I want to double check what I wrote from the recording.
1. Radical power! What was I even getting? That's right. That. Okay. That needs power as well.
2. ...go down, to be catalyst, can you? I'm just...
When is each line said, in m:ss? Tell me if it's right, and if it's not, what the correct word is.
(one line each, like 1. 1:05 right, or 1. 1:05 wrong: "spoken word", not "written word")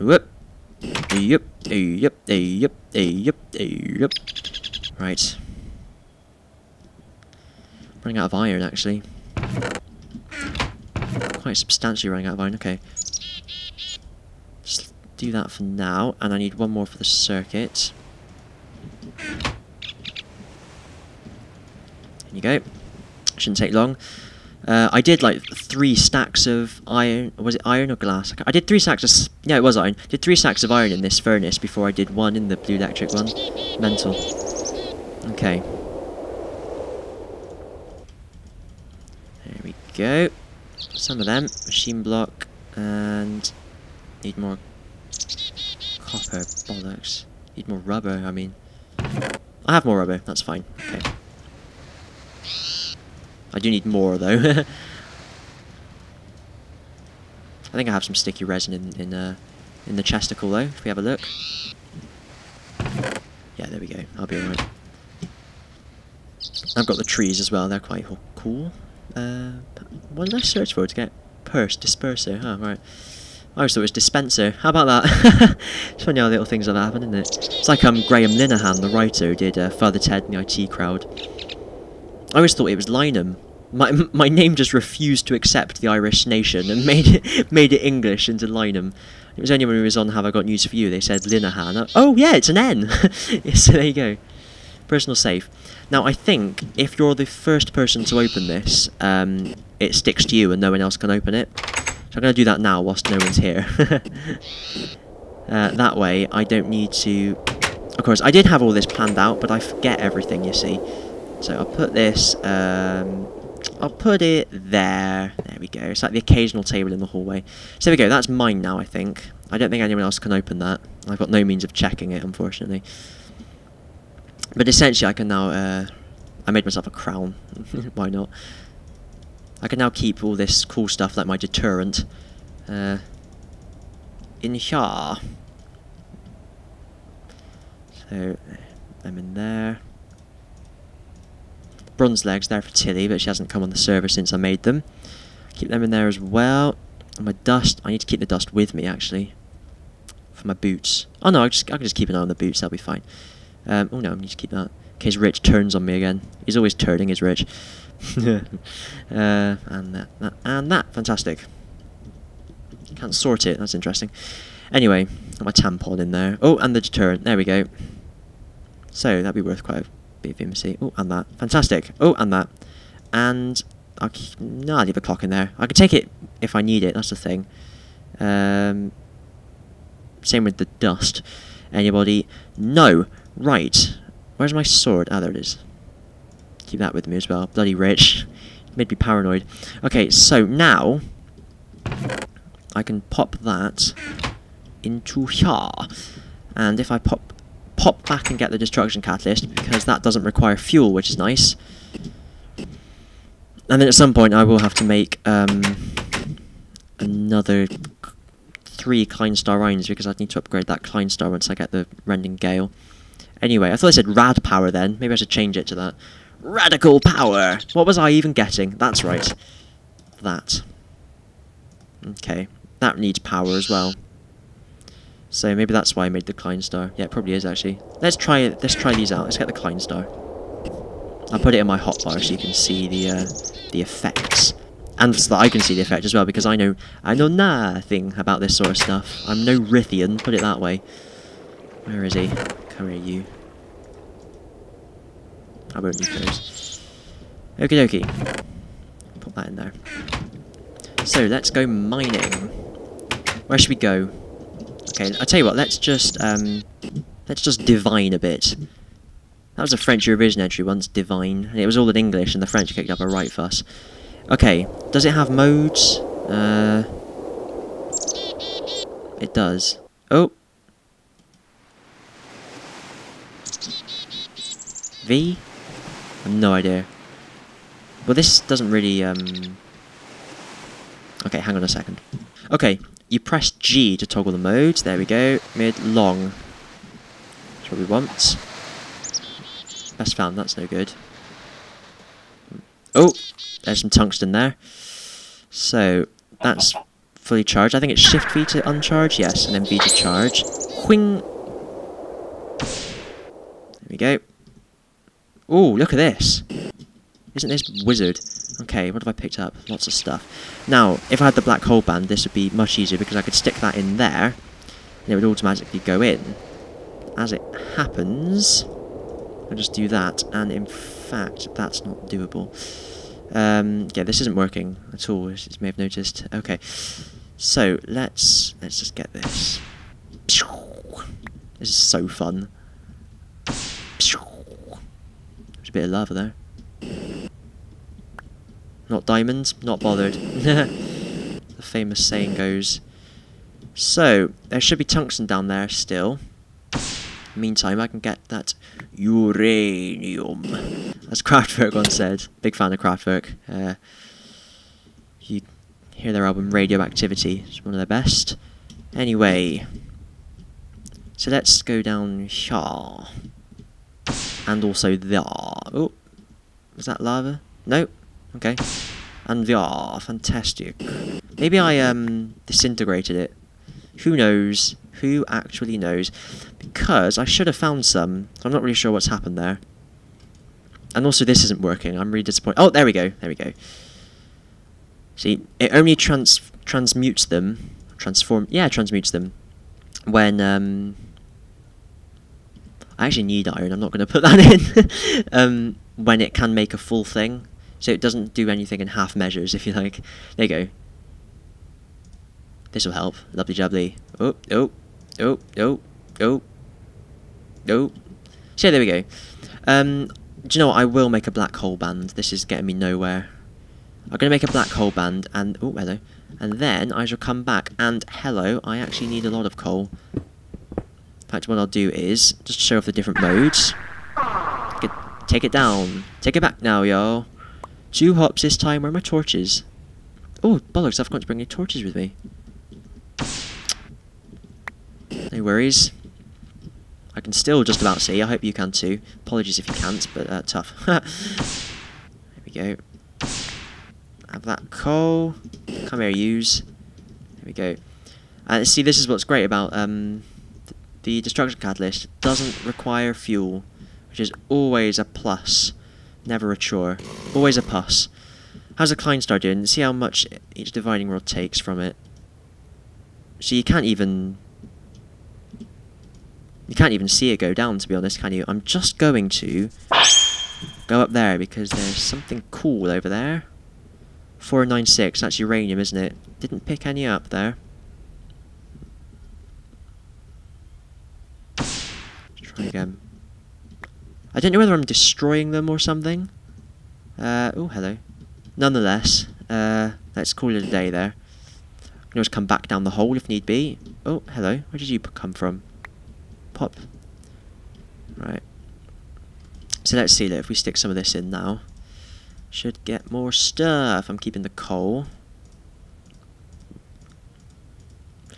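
1. 3:36 right
2. 7:47 wrong: "honest", not "catalyst".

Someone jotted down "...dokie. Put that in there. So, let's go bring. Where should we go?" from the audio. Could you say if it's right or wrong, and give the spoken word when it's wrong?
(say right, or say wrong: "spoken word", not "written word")
wrong: "mining", not "bring".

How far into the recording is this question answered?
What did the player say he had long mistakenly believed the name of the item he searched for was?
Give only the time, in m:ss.
1:13.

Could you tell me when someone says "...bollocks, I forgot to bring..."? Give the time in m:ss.
7:10.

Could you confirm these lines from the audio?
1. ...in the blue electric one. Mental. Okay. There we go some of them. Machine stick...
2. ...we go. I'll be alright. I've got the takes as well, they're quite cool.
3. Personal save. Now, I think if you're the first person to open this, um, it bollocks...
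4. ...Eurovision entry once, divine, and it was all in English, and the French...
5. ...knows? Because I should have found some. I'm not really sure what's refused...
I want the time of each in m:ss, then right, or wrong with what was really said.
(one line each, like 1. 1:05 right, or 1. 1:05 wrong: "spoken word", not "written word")
1. 0:32 wrong: "block", not "stick"
2. 1:03 wrong: "trees", not "takes"
3. 1:34 wrong: "sticks", not "bollocks"
4. 4:20 right
5. 6:15 wrong: "happened", not "refused".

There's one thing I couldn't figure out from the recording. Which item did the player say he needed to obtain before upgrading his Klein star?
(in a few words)
Rending Gale.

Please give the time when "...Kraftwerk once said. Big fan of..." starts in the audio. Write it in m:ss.
5:51.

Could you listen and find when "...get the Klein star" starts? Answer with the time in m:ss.
3:49.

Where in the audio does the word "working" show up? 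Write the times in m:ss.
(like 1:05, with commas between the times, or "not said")
5:24, 6:21.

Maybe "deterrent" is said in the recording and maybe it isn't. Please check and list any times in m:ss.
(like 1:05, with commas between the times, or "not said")
2:11, 2:46.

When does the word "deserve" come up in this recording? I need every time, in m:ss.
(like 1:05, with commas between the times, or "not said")
not said.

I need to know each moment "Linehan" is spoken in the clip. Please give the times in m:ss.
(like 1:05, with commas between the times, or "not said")
1:18, 1:31.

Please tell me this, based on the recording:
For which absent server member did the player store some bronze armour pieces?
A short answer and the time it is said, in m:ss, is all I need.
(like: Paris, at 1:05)
Tilly, at 2:22.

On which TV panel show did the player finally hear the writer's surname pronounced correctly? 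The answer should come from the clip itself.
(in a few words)
Have I Got News for You.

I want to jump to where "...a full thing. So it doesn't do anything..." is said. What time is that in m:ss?
6:36.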